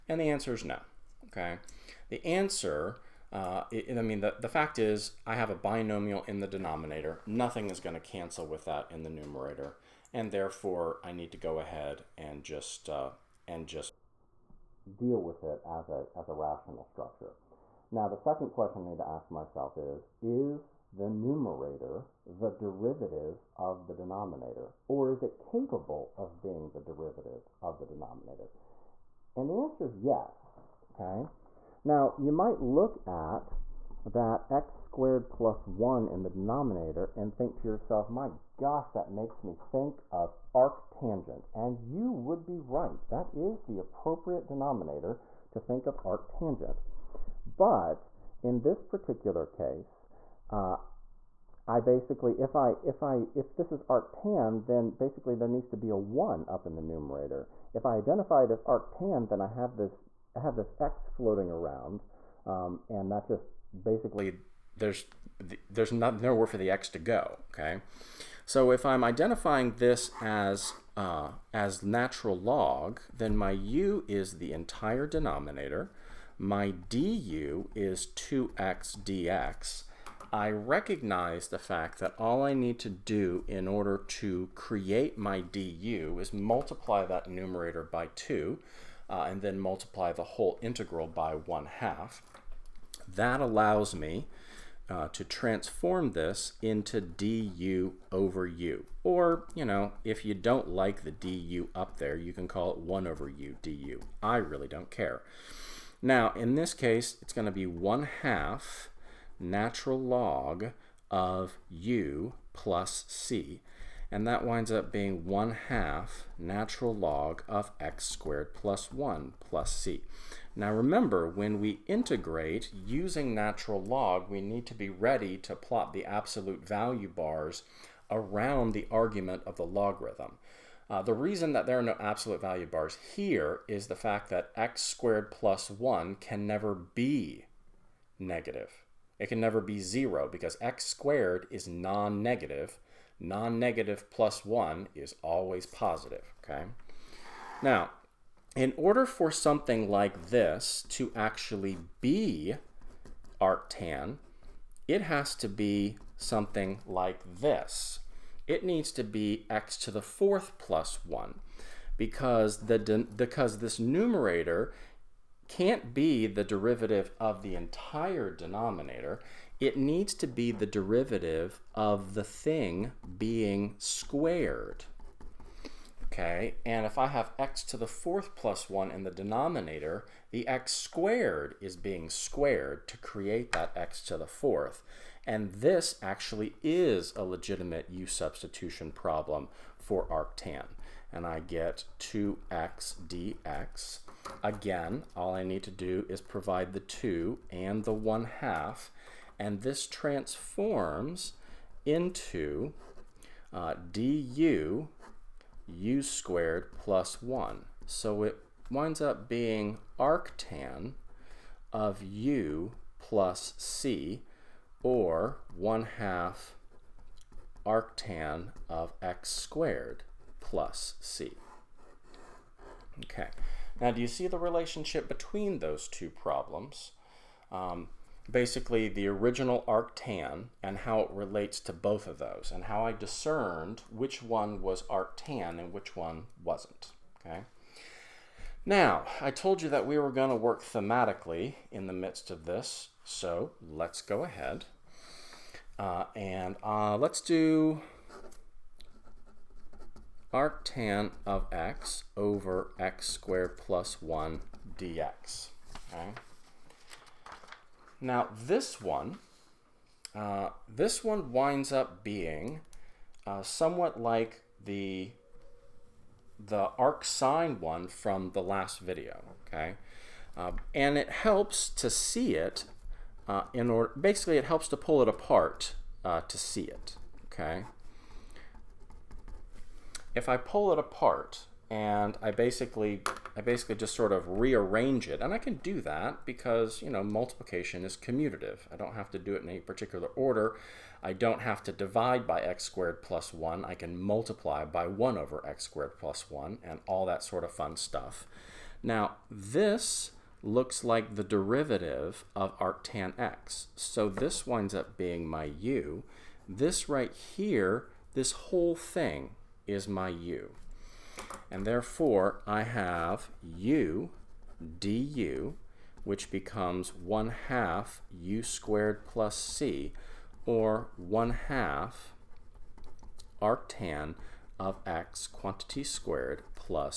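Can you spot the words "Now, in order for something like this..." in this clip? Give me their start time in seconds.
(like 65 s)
147 s.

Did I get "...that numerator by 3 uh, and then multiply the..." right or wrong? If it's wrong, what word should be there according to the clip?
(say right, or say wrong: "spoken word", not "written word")
wrong: "2", not "3".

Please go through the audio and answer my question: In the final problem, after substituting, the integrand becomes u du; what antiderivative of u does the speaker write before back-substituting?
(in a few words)
1/2 u^2 + C.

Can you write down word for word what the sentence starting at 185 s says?
And this actually is a legitimate u substitution problem for arctan.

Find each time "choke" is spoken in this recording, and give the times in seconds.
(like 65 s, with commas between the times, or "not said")
not said.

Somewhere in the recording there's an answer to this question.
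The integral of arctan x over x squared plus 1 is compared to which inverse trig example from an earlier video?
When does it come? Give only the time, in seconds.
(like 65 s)
266 s.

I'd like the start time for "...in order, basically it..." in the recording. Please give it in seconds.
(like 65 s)
273 s.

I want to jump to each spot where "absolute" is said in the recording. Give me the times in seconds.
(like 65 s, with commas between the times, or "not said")
126 s, 132 s.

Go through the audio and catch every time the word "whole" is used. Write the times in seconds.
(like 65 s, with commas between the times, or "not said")
90 s, 308 s.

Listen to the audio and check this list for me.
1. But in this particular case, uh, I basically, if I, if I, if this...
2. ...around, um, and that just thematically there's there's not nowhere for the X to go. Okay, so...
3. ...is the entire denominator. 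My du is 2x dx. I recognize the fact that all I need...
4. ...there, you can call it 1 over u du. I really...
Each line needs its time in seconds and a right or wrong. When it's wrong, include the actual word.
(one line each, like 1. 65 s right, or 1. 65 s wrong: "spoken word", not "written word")
1. 47 s right
2. 61 s wrong: "basically", not "thematically"
3. 74 s right
4. 101 s right.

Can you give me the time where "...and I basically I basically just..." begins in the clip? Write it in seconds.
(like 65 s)
281 s.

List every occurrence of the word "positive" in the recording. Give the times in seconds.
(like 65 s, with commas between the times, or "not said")
145 s.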